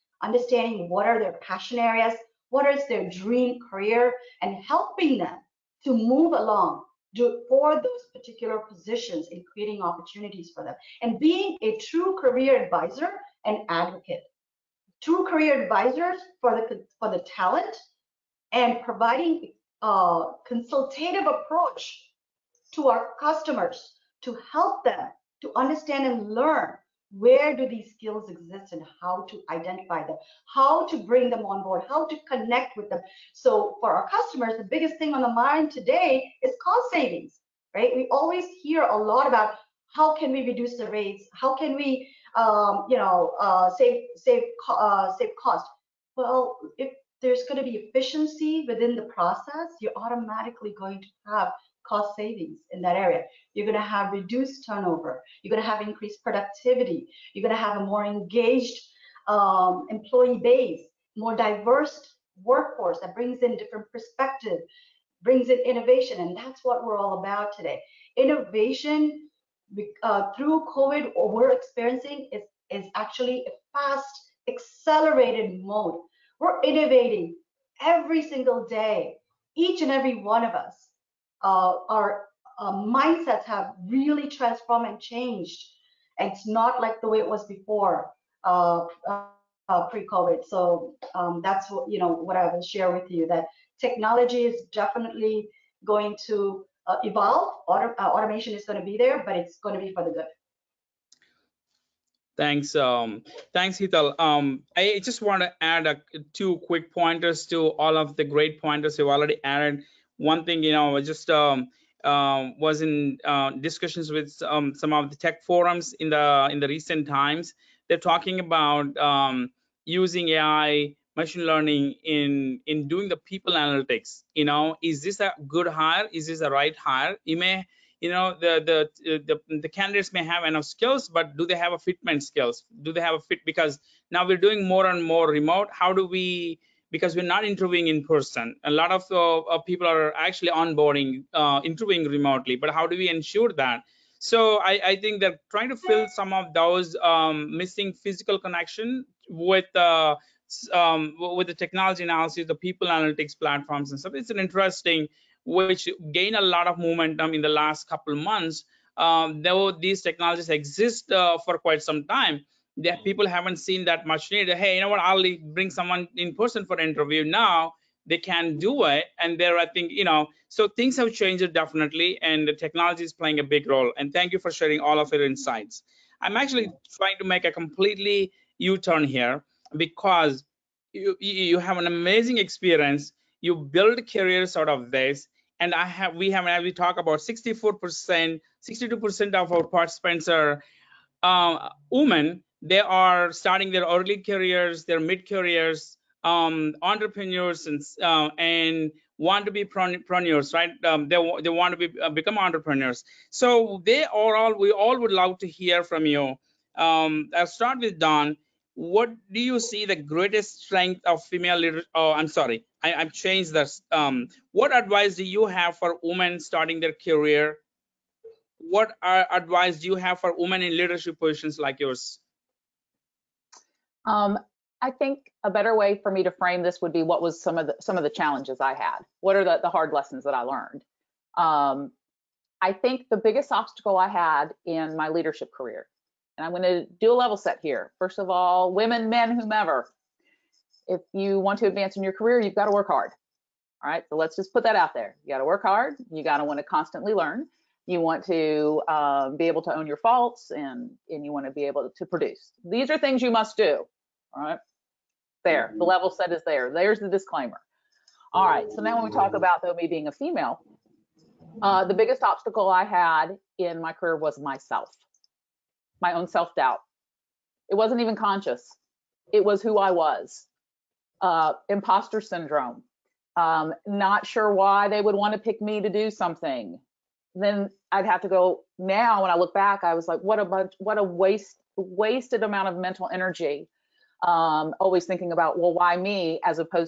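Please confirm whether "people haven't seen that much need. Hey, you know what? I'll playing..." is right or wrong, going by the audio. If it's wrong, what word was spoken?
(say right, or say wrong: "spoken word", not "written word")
wrong: "bring", not "playing".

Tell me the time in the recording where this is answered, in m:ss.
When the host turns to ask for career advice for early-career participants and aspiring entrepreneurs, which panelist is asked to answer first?
3:27.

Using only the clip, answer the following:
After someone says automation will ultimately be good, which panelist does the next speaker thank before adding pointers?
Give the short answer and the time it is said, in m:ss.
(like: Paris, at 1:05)
Hetal, at 1:43.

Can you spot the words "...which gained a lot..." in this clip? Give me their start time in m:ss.
2:35.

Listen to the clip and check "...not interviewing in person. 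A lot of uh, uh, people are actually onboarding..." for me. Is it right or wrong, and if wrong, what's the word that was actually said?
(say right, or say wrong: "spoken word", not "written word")
right.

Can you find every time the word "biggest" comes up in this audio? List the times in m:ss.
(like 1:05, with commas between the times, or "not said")
0:34, 3:53, 4:21.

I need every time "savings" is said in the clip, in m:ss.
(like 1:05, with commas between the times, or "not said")
0:36, 0:52.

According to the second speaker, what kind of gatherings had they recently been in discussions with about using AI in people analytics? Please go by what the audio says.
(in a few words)
tech forums.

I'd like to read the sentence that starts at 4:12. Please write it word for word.
These are things you must do all right.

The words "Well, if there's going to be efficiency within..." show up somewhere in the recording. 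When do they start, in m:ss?
0:46.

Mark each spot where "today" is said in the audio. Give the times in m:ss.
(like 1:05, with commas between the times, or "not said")
0:35, 1:07.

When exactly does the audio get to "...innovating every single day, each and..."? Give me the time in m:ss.
1:16.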